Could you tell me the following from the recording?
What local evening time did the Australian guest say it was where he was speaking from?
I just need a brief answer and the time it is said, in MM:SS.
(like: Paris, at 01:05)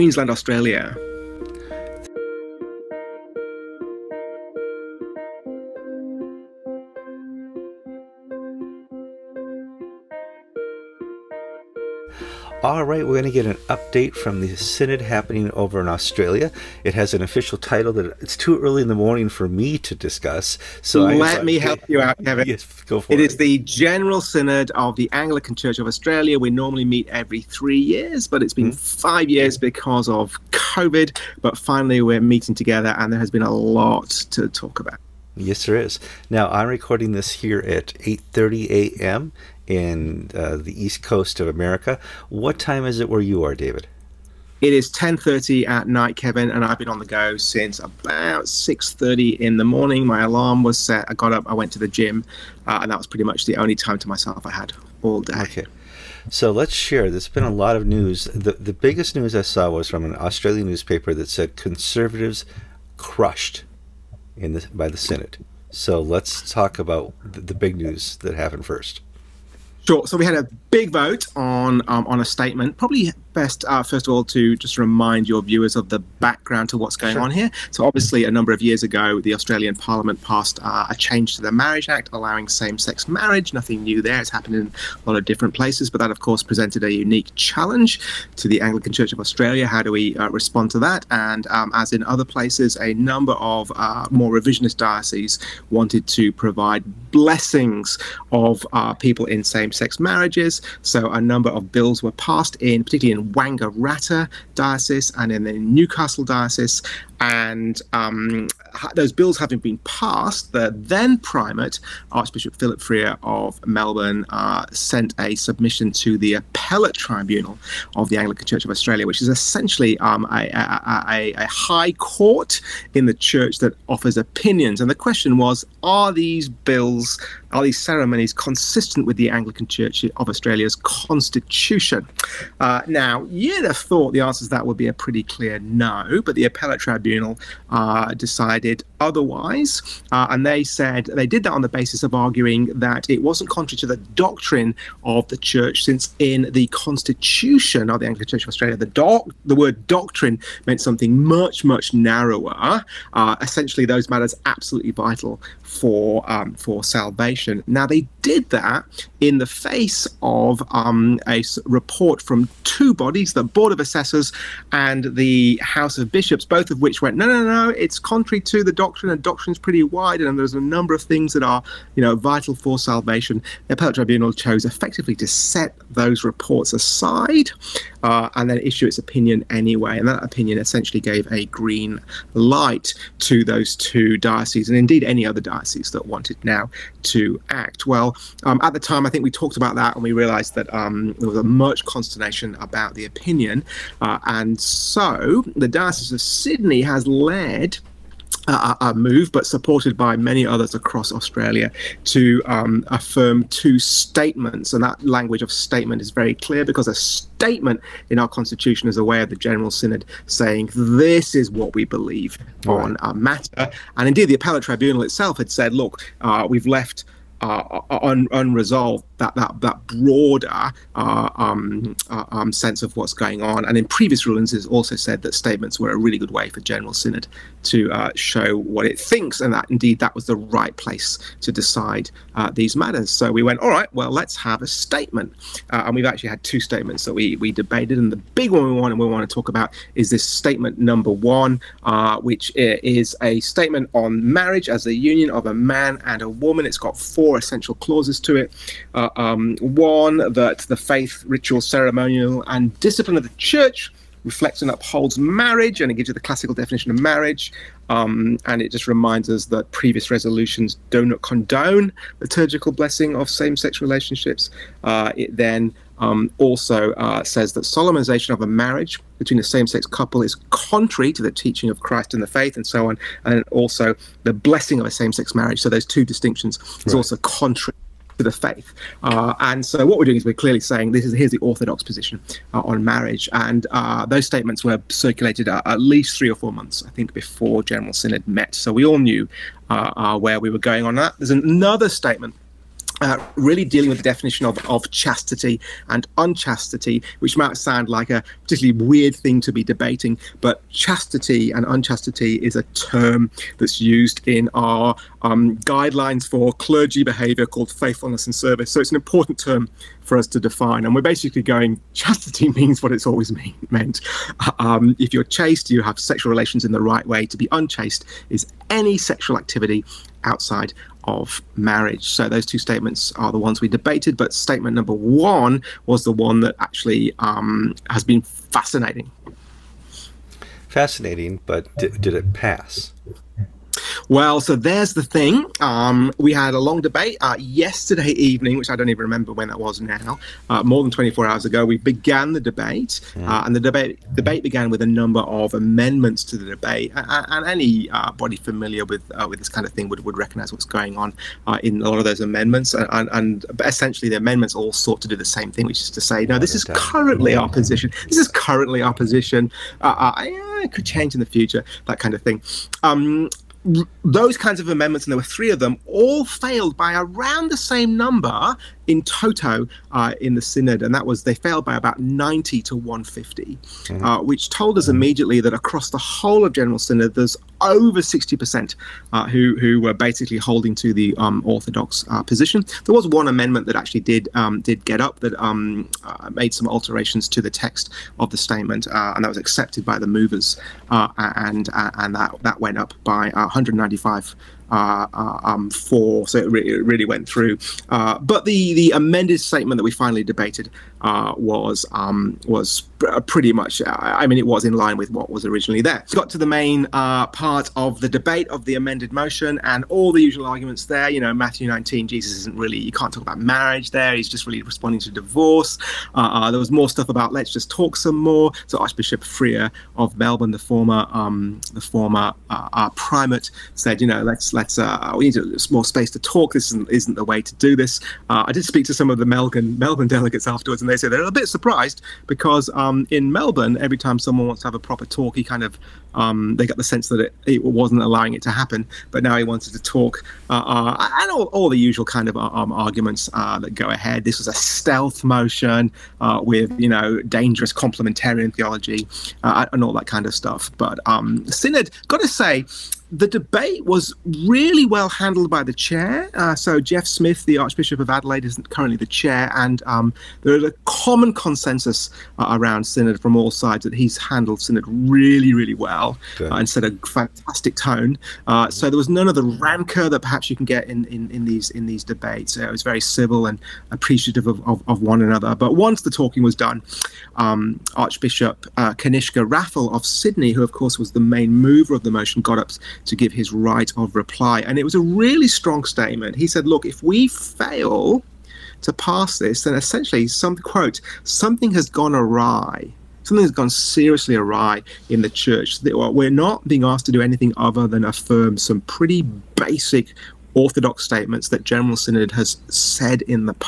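10:30 at night, at 00:44.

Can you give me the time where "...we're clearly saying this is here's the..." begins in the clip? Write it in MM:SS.
04:40.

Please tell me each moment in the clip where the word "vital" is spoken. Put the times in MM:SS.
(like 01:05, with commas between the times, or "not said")
02:34, 02:52.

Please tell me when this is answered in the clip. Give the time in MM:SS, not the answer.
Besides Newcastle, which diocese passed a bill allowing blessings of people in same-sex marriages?
01:43.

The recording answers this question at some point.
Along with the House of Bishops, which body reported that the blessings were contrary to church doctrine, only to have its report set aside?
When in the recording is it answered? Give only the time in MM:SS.
02:43.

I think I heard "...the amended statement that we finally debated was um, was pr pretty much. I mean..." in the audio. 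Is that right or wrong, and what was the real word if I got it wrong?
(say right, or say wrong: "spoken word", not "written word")
right.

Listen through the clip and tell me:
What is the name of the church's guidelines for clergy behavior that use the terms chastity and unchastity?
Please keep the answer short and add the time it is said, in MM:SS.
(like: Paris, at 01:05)
Faithfulness and Service, at 05:07.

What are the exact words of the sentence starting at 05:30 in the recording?
Fascinating, but d- did it pass?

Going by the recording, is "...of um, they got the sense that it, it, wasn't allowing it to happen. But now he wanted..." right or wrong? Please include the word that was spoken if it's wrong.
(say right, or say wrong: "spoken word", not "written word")
right.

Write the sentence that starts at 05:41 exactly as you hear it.
We began the debate, uh, hmm.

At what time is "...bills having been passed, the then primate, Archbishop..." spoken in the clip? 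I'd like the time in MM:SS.
01:49.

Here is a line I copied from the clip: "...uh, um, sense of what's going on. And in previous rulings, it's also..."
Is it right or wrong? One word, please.
right.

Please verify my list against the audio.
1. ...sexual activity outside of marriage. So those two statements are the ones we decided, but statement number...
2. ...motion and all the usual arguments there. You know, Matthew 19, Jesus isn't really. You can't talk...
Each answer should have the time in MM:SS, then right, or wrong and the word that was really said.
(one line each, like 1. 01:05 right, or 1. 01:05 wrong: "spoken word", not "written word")
1. 05:18 wrong: "debated", not "decided"
2. 06:49 right.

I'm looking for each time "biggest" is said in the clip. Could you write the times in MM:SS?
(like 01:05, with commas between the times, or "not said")
00:58.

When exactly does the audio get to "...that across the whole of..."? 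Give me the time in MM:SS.
06:15.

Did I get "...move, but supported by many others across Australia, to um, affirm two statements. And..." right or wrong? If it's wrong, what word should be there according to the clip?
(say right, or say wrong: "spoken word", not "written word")
right.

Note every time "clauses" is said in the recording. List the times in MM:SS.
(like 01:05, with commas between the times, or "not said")
04:07.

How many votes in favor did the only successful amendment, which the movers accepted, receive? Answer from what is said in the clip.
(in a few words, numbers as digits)
195.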